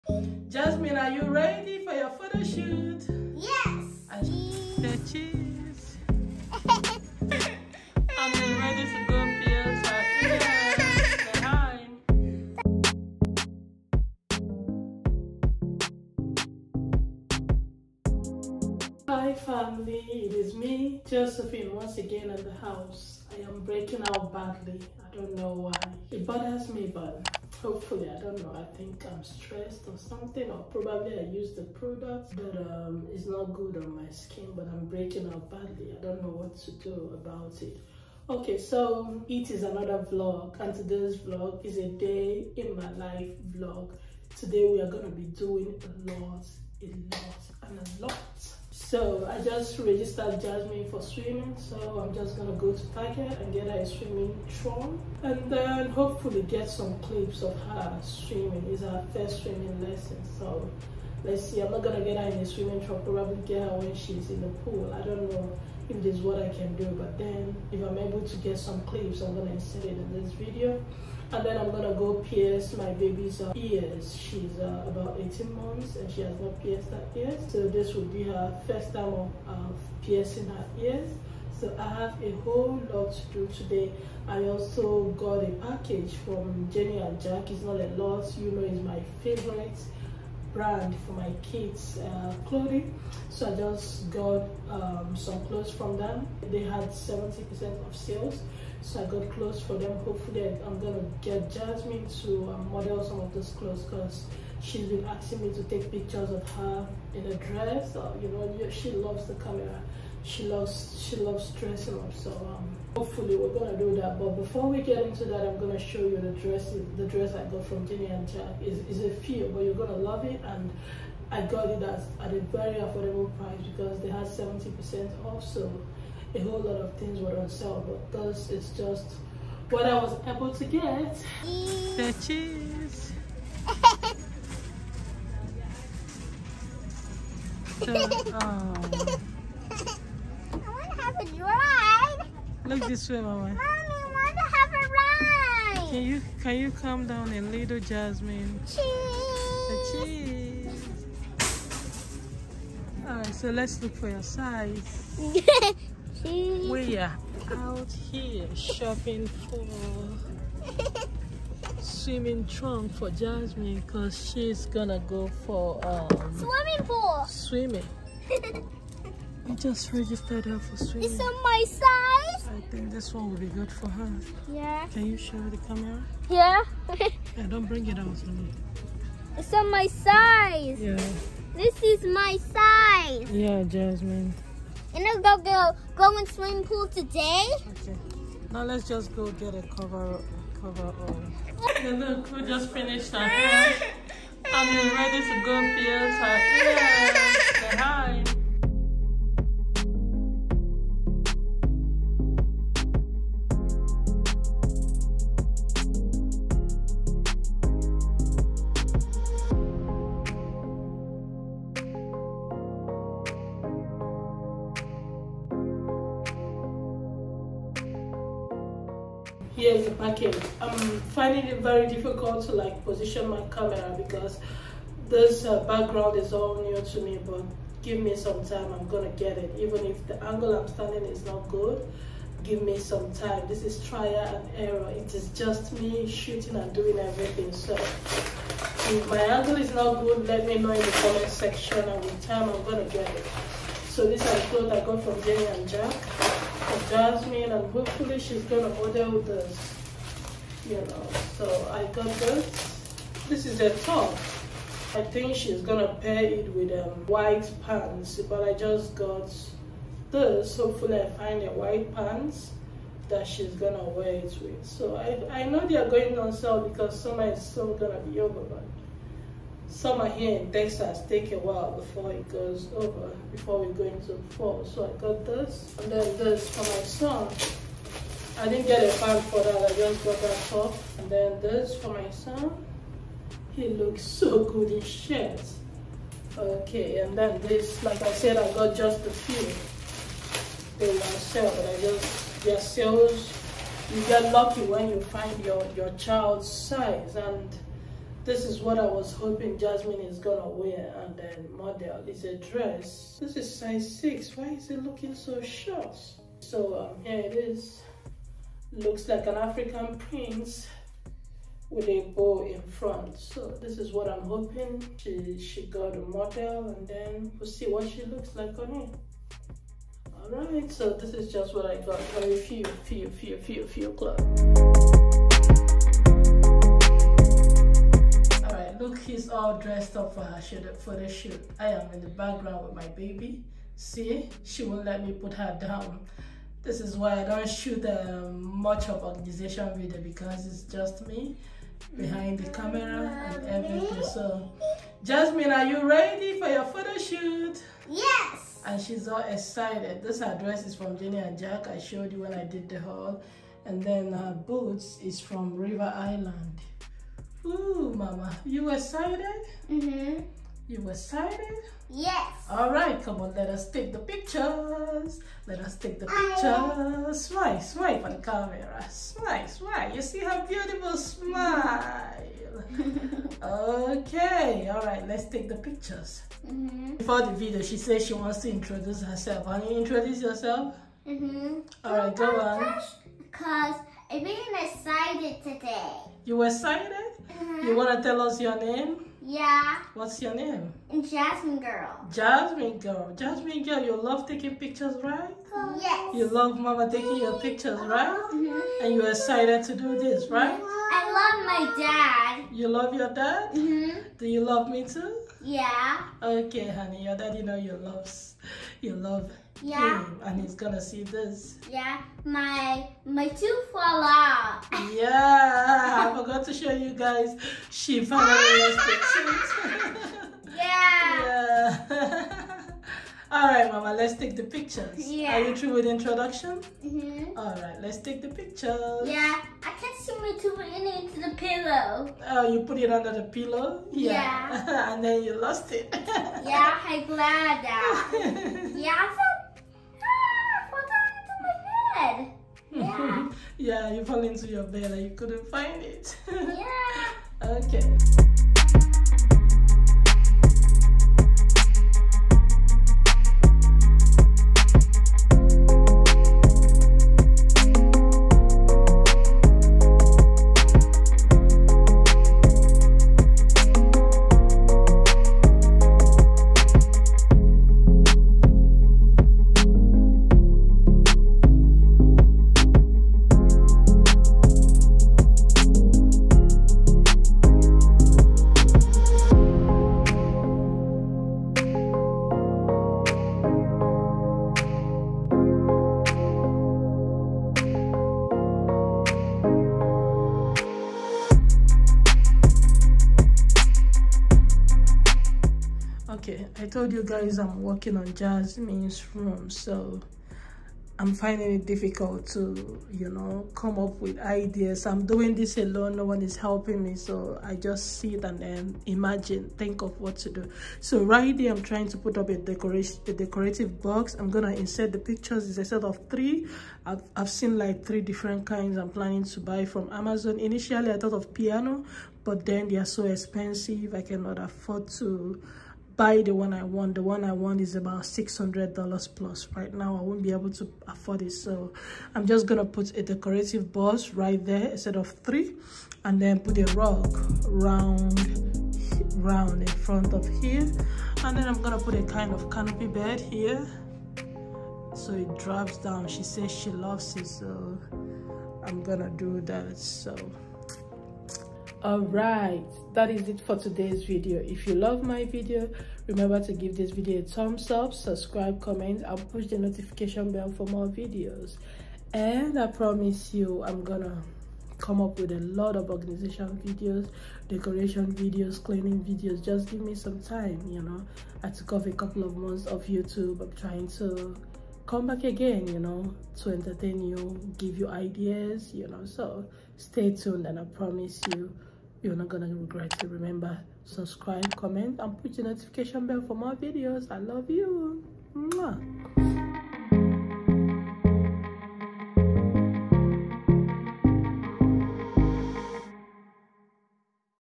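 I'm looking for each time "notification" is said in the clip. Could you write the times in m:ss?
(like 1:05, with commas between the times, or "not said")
9:19, 9:45.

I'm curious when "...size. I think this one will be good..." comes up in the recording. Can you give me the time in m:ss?
2:51.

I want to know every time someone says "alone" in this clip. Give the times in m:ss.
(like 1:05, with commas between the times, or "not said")
8:25.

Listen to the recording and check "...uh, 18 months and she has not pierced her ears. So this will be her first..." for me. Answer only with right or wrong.
right.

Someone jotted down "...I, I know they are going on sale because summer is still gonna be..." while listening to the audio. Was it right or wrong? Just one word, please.
right.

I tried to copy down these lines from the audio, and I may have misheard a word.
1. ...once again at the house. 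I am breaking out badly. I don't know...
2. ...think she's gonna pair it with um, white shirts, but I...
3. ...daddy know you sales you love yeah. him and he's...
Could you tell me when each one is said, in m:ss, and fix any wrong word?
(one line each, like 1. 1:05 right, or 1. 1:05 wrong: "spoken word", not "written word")
1. 0:21 right
2. 4:15 wrong: "pants", not "shirts"
3. 6:47 wrong: "loves", not "sales".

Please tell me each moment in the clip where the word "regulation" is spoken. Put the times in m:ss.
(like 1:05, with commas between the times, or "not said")
not said.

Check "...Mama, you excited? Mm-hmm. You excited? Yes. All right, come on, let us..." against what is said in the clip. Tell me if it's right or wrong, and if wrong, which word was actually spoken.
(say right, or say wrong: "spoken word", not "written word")
right.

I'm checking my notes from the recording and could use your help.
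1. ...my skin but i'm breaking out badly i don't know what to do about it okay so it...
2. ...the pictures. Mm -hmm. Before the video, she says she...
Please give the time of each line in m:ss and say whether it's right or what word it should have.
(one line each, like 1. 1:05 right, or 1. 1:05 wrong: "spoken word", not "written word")
1. 0:34 right
2. 6:15 right.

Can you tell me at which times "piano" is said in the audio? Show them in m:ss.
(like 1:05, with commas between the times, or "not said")
8:41.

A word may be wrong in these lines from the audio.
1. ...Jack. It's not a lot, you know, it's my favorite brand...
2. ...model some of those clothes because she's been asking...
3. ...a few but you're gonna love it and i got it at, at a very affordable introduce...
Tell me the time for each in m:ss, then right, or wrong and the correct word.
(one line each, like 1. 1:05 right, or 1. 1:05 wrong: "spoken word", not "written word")
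1. 1:27 right
2. 1:42 right
3. 1:59 wrong: "price", not "introduce".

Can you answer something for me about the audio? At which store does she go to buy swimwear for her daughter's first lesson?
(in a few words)
Tiger.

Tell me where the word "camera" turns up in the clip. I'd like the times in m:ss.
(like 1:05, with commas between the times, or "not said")
1:49, 2:55, 3:43, 5:42, 6:08.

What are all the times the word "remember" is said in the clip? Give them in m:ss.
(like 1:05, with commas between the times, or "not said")
9:16, 9:43.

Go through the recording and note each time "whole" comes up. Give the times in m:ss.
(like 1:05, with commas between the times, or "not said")
1:22, 2:06.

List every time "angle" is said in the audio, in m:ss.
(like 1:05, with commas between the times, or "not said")
3:50, 3:59.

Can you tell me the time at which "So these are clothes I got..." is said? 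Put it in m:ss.
4:03.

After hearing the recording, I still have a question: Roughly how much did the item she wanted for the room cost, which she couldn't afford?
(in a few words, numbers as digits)
$600 plus.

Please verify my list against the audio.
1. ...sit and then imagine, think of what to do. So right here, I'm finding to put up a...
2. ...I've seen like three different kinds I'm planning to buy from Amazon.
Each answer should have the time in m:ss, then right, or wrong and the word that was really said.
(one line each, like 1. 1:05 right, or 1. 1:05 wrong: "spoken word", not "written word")
1. 8:27 wrong: "trying", not "finding"
2. 8:37 right.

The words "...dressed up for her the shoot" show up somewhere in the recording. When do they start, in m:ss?
5:29.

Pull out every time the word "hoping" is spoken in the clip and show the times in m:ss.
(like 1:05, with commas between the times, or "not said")
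4:59, 5:14.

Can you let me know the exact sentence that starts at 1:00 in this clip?
So let's see, I'm not gonna get her in the swimming tron, probably get her when she's in the pool.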